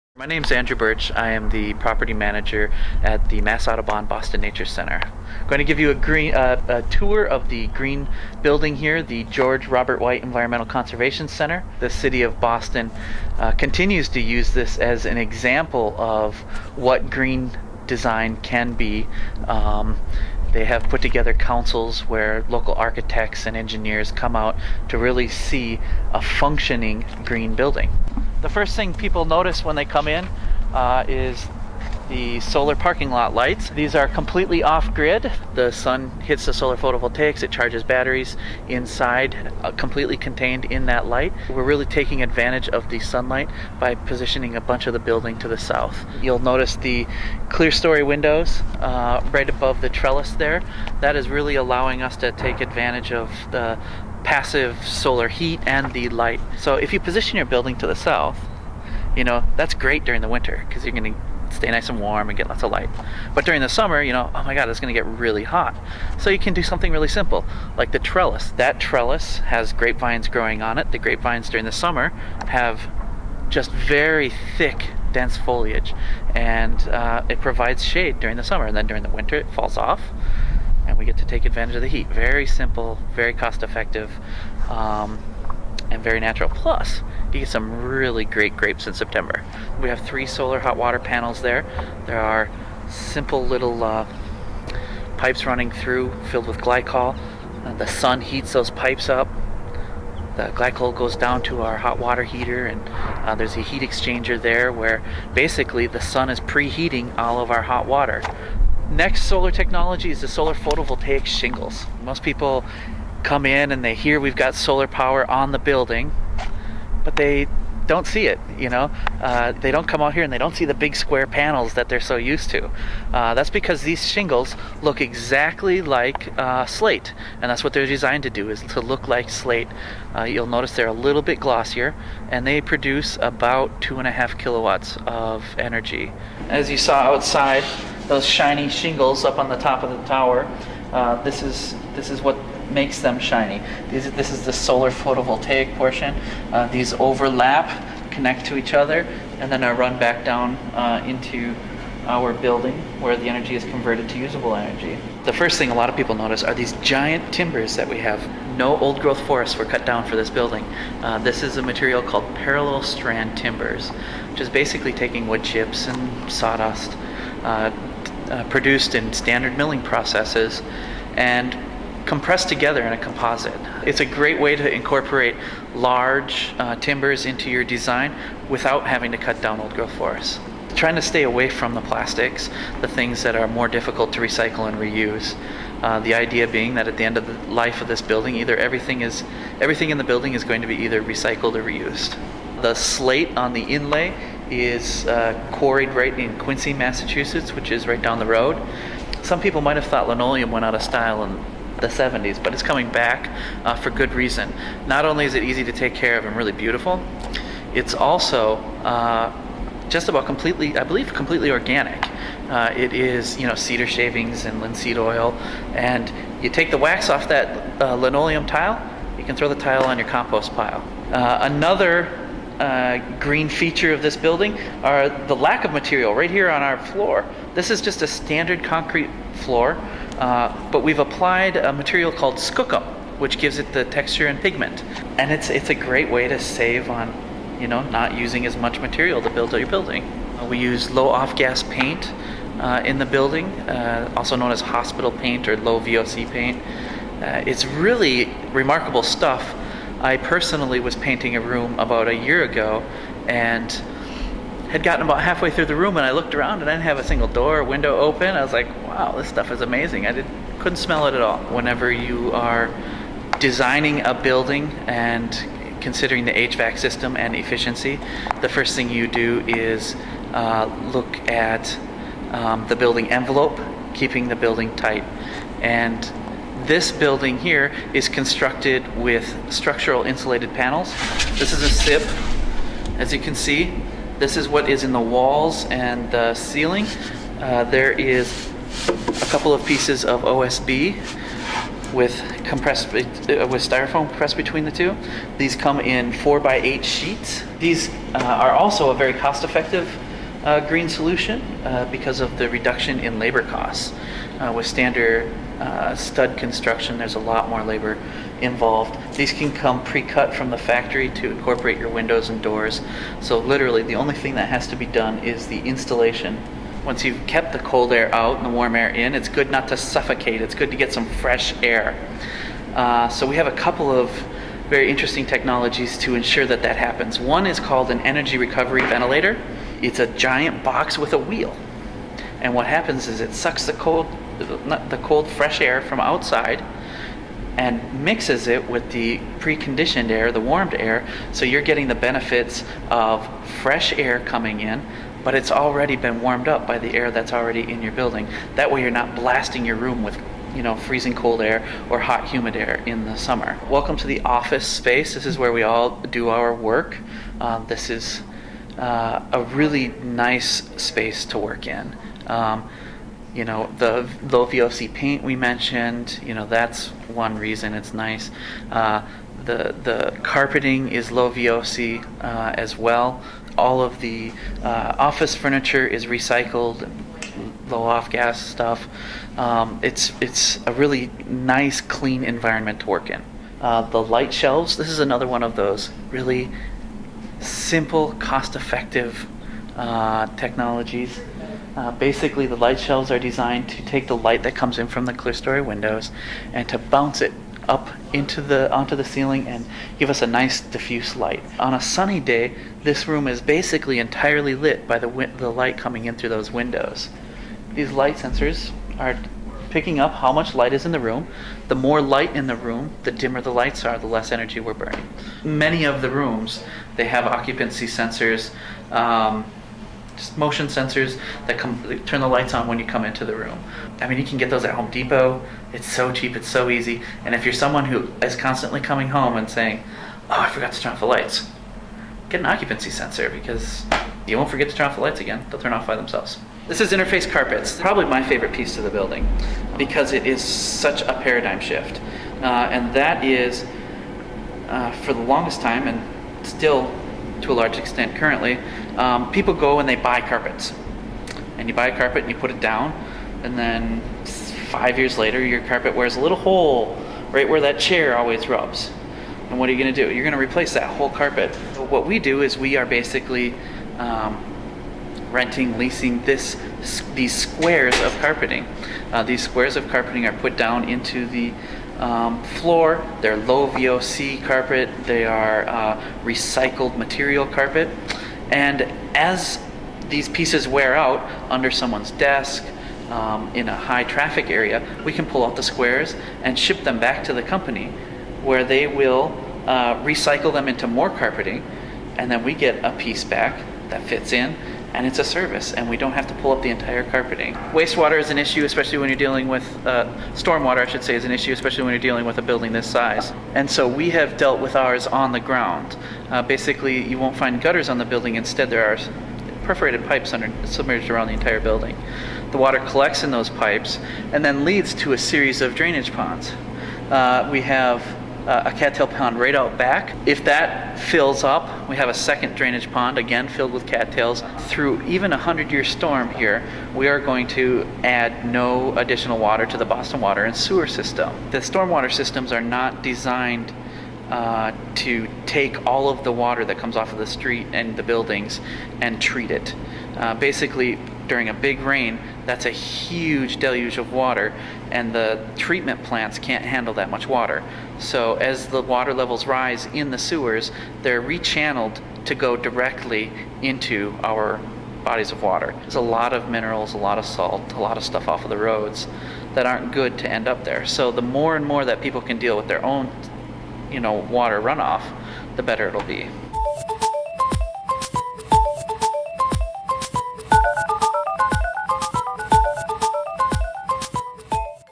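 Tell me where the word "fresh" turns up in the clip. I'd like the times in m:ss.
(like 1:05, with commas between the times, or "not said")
5:21, 5:35, 5:43.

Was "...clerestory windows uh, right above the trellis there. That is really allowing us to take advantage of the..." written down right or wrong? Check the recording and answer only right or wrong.
right.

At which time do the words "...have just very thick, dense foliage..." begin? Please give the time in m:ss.
1:12.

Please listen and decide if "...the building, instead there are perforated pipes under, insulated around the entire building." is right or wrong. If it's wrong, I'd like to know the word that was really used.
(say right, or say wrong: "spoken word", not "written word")
wrong: "submerged", not "insulated".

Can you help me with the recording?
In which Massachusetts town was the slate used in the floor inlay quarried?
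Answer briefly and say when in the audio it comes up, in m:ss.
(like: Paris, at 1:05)
Quincy, at 3:16.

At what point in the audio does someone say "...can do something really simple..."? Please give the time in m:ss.
1:06.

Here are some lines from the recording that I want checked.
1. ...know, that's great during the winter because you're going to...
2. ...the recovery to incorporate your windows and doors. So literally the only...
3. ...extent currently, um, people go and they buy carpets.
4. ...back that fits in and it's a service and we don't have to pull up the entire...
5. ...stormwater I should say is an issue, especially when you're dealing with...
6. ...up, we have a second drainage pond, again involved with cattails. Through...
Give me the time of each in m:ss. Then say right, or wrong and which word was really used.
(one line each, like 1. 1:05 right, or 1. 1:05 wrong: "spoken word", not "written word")
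1. 0:59 right
2. 5:10 wrong: "factory", not "recovery"
3. 7:27 right
4. 8:13 right
5. 8:20 right
6. 8:41 wrong: "filled", not "involved".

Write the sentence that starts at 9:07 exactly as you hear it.
So, as the water levels rise in the sewers, they're rechanneled to go directly into our bodies of water.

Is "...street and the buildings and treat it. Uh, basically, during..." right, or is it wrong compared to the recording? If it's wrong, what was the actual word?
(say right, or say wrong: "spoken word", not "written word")
right.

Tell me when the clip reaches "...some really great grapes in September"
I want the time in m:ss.
1:27.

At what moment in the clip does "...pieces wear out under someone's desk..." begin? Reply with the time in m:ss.
8:00.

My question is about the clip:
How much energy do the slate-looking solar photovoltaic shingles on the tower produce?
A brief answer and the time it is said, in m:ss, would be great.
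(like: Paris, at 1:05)
2.5 kilowatts, at 2:13.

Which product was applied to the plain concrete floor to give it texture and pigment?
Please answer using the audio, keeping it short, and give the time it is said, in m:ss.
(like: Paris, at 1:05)
skookum, at 3:52.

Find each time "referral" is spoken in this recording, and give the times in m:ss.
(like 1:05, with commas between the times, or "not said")
not said.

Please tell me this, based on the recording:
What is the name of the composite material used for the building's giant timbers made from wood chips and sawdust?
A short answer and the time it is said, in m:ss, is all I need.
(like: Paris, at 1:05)
parallel strand timbers, at 2:42.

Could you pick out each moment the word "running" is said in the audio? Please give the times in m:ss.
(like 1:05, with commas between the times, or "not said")
1:35.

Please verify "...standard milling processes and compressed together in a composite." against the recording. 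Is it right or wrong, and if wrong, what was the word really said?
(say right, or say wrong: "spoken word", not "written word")
right.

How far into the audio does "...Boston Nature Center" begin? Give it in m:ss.
0:04.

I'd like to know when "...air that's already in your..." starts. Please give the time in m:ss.
5:46.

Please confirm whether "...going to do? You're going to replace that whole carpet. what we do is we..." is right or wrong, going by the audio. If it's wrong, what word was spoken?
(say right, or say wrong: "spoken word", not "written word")
right.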